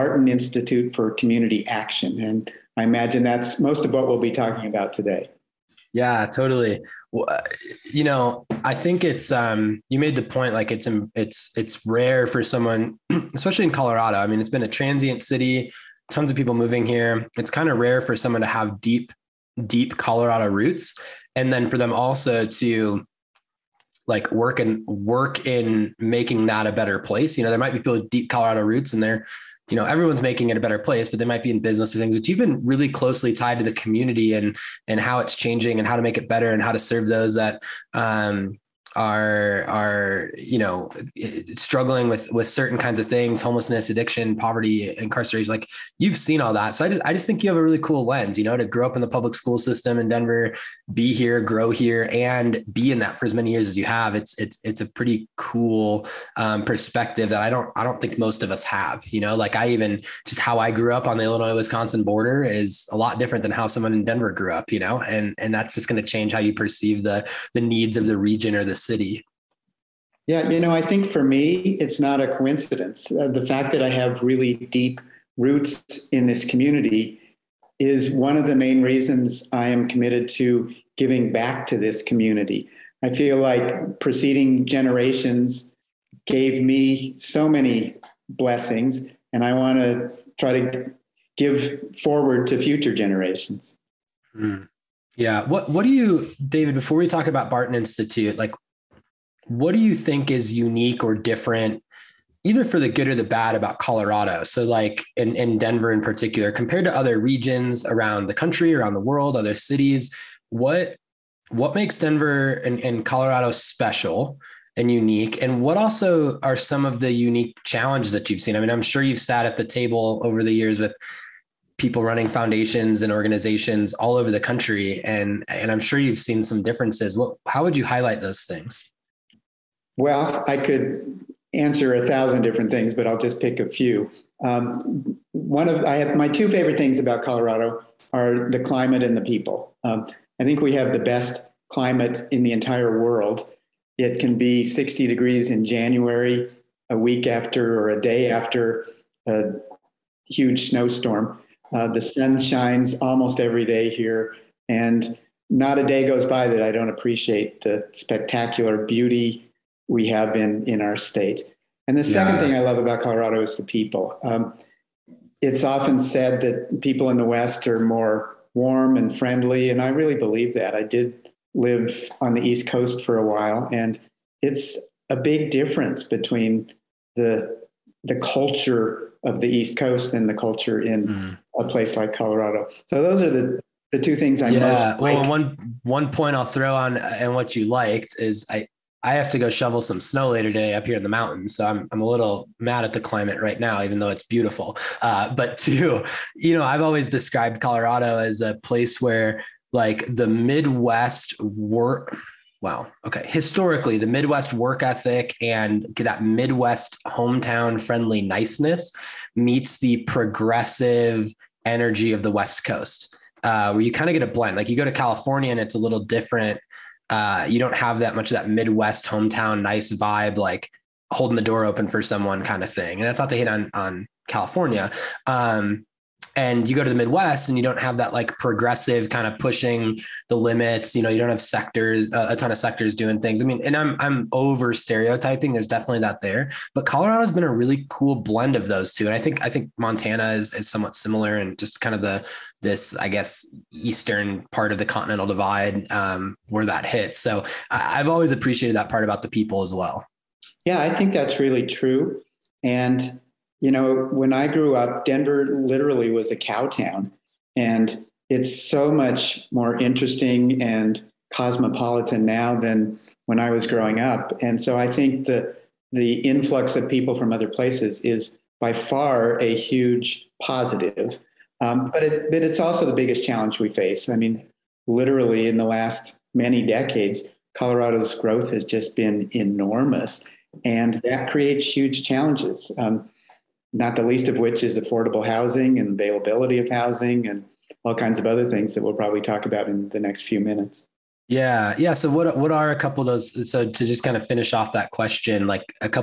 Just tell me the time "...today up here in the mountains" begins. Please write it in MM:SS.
03:10.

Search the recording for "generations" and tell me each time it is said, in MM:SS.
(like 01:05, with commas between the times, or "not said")
01:24, 01:32.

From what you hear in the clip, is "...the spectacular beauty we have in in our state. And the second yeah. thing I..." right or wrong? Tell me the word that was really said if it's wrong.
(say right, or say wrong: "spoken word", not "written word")
right.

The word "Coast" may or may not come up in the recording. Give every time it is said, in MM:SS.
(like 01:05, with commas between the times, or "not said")
02:52, 02:59, 03:32.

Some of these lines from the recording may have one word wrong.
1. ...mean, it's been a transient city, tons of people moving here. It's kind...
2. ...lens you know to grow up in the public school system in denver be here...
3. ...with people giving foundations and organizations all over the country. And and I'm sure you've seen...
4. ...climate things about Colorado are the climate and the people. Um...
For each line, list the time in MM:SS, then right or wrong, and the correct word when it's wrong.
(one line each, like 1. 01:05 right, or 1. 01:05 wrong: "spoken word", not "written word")
1. 00:14 right
2. 00:48 right
3. 02:00 wrong: "running", not "giving"
4. 02:16 wrong: "favorite", not "climate".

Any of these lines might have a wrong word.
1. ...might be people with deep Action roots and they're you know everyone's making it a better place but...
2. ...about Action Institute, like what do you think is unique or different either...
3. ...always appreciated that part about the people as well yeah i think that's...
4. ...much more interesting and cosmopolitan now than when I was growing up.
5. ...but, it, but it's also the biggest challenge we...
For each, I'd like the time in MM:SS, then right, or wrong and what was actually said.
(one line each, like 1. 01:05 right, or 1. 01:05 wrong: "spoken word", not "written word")
1. 00:27 wrong: "Colorado", not "Action"
2. 01:37 wrong: "Barton", not "Action"
3. 04:08 right
4. 04:18 right
5. 04:31 right.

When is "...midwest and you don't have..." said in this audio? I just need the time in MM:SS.
03:46.